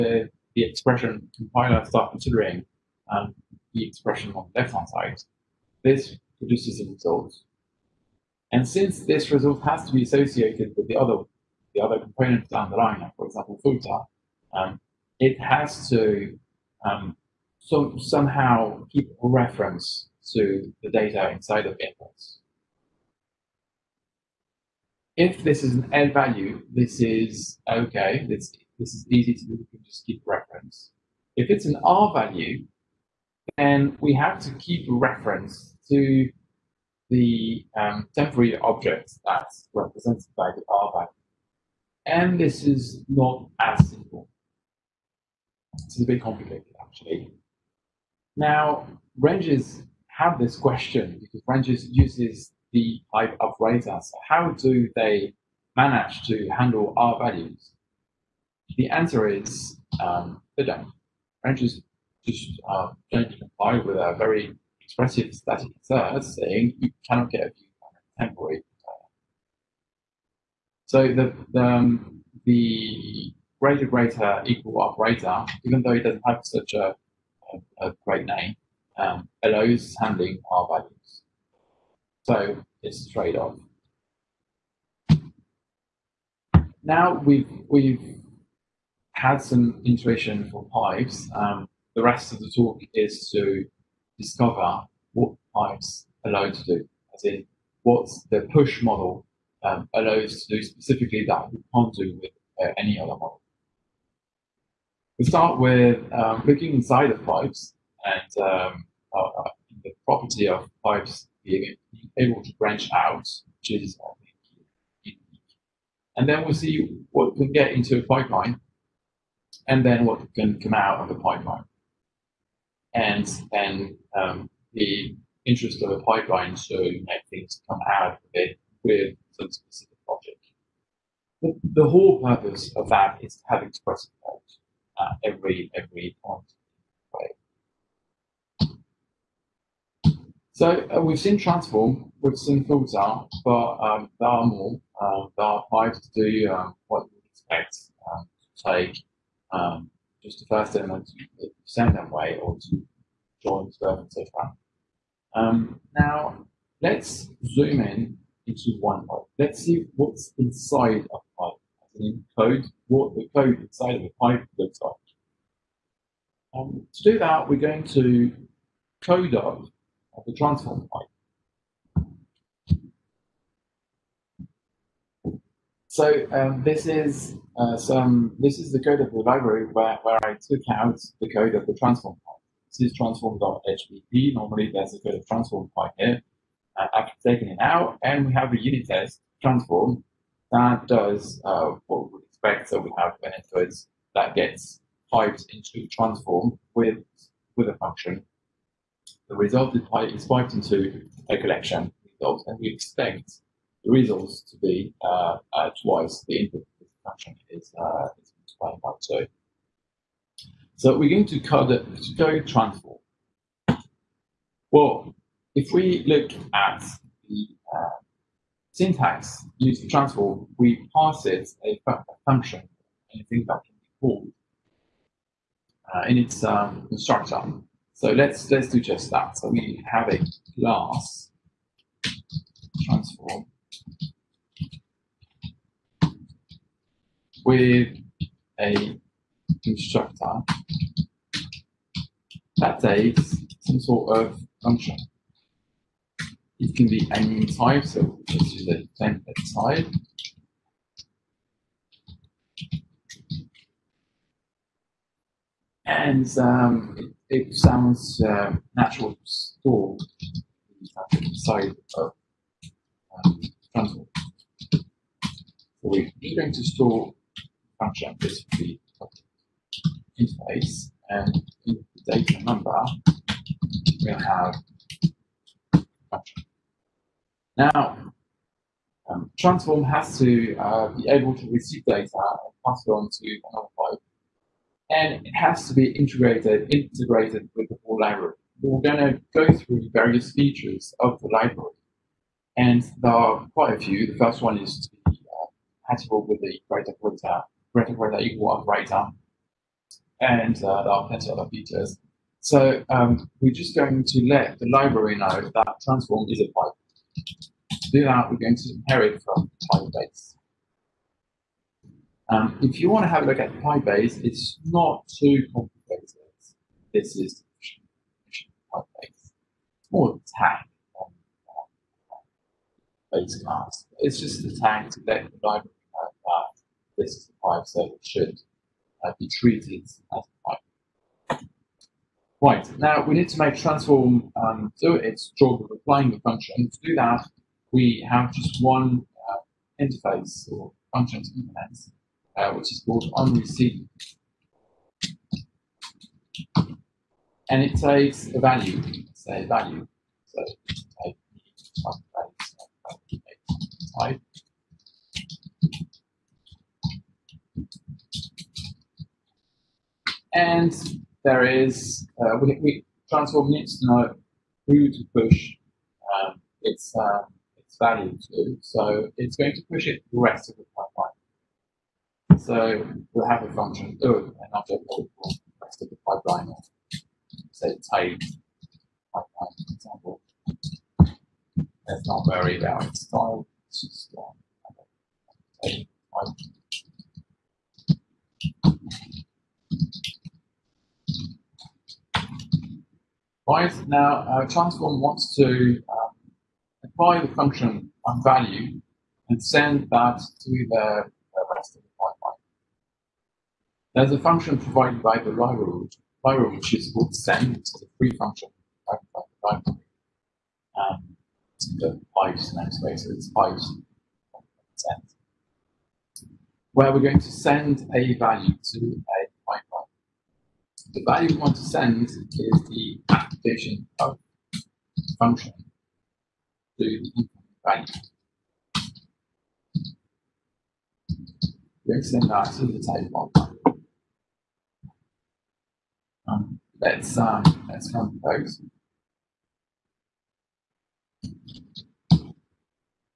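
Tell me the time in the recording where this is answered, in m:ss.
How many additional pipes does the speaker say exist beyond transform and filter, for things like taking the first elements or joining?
2:25.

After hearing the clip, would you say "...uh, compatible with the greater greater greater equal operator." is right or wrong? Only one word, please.
right.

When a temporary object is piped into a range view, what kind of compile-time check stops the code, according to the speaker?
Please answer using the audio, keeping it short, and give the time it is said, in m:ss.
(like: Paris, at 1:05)
static assert, at 1:05.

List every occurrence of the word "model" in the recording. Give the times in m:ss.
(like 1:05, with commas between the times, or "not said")
1:38, 1:43.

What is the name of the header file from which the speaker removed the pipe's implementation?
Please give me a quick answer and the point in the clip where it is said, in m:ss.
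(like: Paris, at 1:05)
transform.hpp, at 3:02.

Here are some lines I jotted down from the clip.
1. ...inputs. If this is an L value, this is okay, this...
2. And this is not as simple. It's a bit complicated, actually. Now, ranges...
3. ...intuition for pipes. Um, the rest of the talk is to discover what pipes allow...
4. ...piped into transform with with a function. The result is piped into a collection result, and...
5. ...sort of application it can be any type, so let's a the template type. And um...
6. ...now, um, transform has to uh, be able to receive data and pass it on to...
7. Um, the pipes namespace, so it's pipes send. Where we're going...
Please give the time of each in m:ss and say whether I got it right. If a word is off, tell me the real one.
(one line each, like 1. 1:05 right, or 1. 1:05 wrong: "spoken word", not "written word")
1. 0:21 right
2. 0:42 right
3. 1:29 right
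4. 3:15 right
5. 4:03 wrong: "function", not "application"
6. 4:37 right
7. 6:50 right.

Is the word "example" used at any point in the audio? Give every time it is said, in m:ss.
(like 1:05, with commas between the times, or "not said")
0:13, 6:19.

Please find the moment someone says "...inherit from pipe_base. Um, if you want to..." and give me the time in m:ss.
5:08.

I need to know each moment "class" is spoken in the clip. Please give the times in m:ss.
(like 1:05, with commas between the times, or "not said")
3:50, 5:23.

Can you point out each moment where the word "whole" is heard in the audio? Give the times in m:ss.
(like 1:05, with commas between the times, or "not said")
2:11, 4:47.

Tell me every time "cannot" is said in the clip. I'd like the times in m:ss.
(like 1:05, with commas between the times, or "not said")
1:07.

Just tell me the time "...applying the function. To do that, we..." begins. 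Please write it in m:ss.
5:35.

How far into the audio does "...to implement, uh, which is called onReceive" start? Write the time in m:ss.
5:41.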